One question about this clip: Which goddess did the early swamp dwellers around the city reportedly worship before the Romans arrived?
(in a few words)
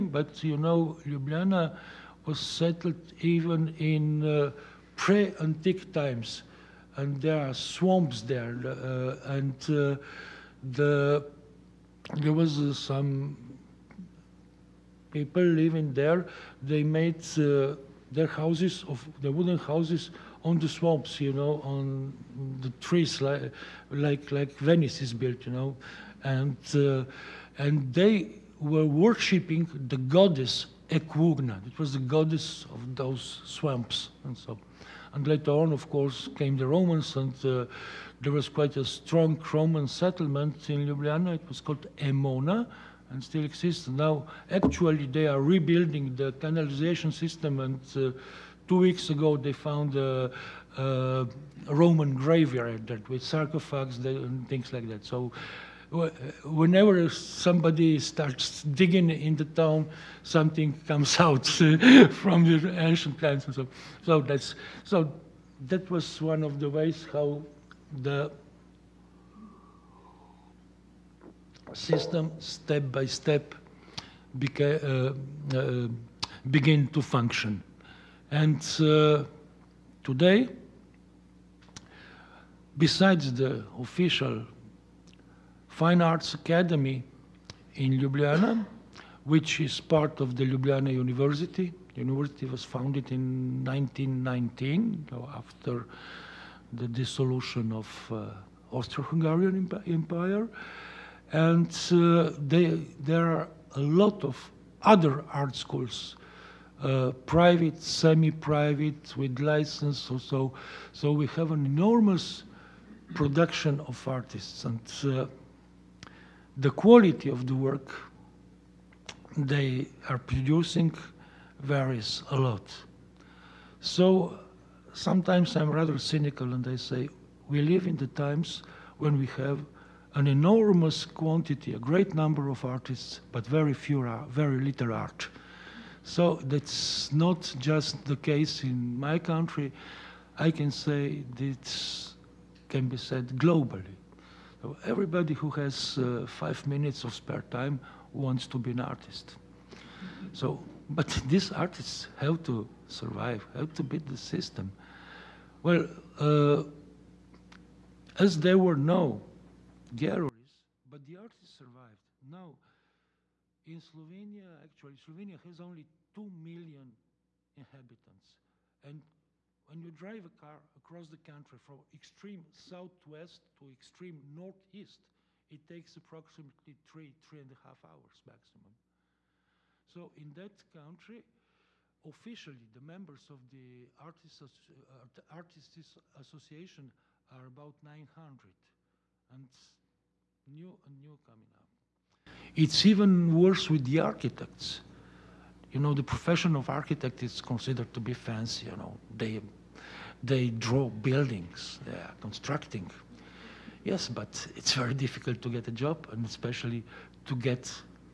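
Equrna.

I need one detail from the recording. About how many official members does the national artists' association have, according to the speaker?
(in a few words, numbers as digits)
900.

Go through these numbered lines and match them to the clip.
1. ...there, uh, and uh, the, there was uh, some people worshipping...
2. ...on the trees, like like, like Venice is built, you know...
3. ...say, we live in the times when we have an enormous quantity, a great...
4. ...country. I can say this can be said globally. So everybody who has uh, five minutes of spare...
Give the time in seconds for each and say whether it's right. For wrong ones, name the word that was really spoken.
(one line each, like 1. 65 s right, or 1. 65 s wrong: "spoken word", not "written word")
1. 8 s wrong: "living", not "worshipping"
2. 21 s right
3. 126 s right
4. 139 s right.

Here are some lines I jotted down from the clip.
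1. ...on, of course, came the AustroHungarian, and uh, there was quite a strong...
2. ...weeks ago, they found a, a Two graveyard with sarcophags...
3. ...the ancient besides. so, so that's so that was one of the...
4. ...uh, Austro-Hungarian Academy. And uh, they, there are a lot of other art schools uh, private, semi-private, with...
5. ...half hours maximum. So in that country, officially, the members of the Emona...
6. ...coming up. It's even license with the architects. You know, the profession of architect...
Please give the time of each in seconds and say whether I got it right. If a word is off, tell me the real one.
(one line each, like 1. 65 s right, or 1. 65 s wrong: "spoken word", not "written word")
1. 35 s wrong: "Romans", not "AustroHungarian"
2. 48 s wrong: "Roman", not "Two"
3. 62 s wrong: "times", not "besides"
4. 98 s wrong: "Empire", not "Academy"
5. 177 s wrong: "Artists", not "Emona"
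6. 191 s wrong: "worse", not "license".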